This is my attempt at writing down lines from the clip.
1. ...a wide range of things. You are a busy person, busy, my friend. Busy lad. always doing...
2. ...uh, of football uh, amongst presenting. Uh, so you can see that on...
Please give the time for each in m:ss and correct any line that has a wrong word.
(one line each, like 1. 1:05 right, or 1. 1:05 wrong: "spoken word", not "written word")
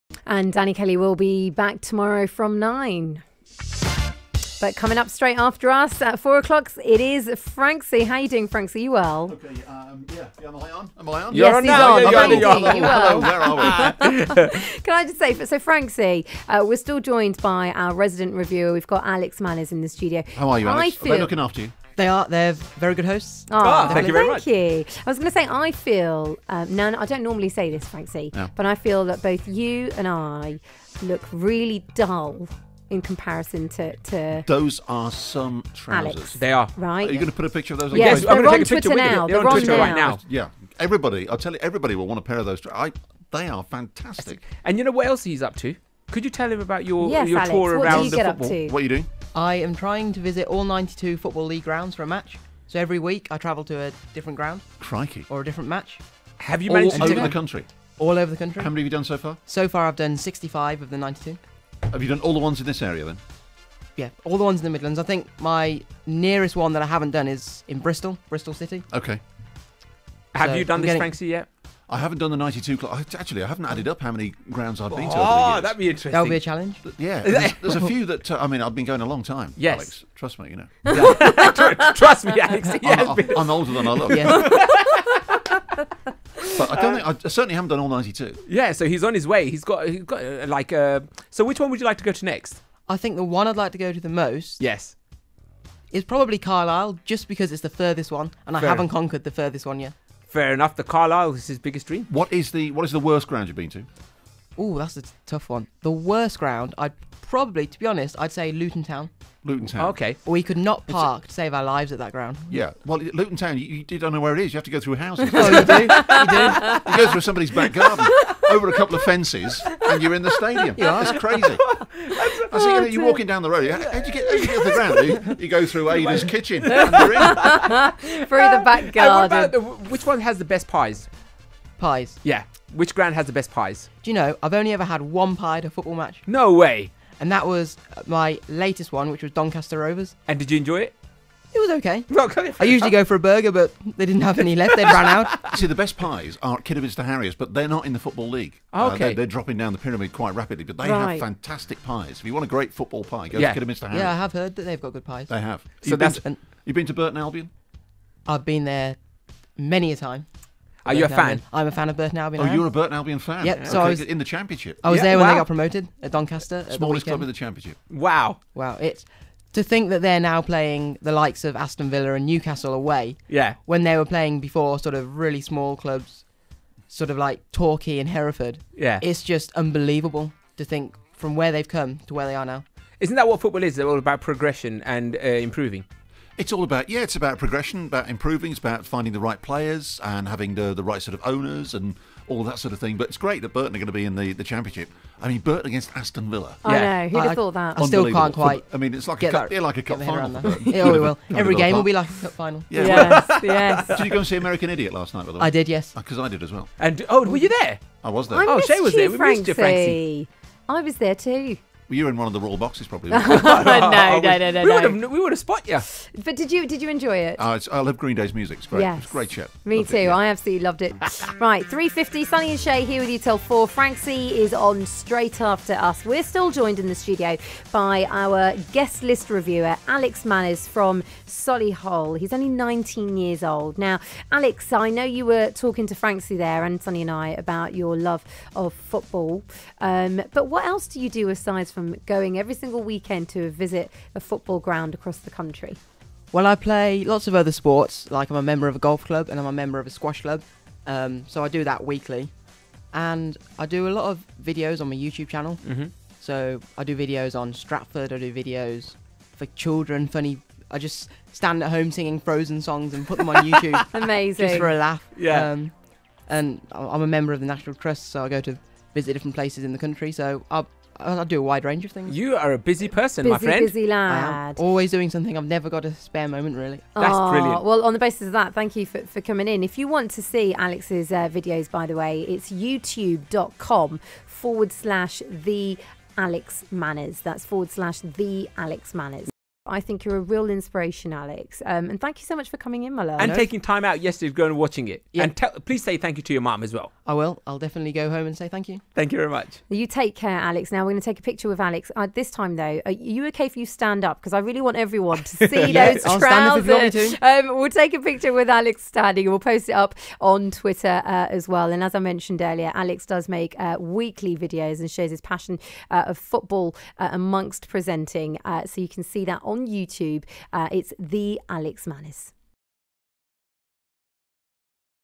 1. 4:31 right
2. 5:15 right.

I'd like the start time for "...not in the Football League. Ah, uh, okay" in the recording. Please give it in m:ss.
2:27.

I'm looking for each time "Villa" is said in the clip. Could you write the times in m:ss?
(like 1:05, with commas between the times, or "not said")
2:51, 3:16.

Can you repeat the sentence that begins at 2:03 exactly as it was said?
How, would you get, how you get to the ground?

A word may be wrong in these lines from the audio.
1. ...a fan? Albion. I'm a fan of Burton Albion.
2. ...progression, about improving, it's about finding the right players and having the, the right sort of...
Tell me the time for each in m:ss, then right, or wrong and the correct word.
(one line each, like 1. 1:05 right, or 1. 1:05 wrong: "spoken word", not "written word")
1. 2:41 right
2. 3:07 right.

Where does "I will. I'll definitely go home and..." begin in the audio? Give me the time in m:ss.
4:57.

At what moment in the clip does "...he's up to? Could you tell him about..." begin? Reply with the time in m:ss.
0:45.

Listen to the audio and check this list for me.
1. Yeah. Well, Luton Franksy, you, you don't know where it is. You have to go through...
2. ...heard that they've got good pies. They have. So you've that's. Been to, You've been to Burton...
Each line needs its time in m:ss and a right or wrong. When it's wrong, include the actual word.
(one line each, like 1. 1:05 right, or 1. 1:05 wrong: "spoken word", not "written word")
1. 1:52 wrong: "Town", not "Franksy"
2. 2:34 right.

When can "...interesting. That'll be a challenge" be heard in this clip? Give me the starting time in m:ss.
1:15.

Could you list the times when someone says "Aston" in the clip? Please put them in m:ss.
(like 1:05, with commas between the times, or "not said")
2:51, 3:15.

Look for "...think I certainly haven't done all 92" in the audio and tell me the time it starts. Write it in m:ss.
1:27.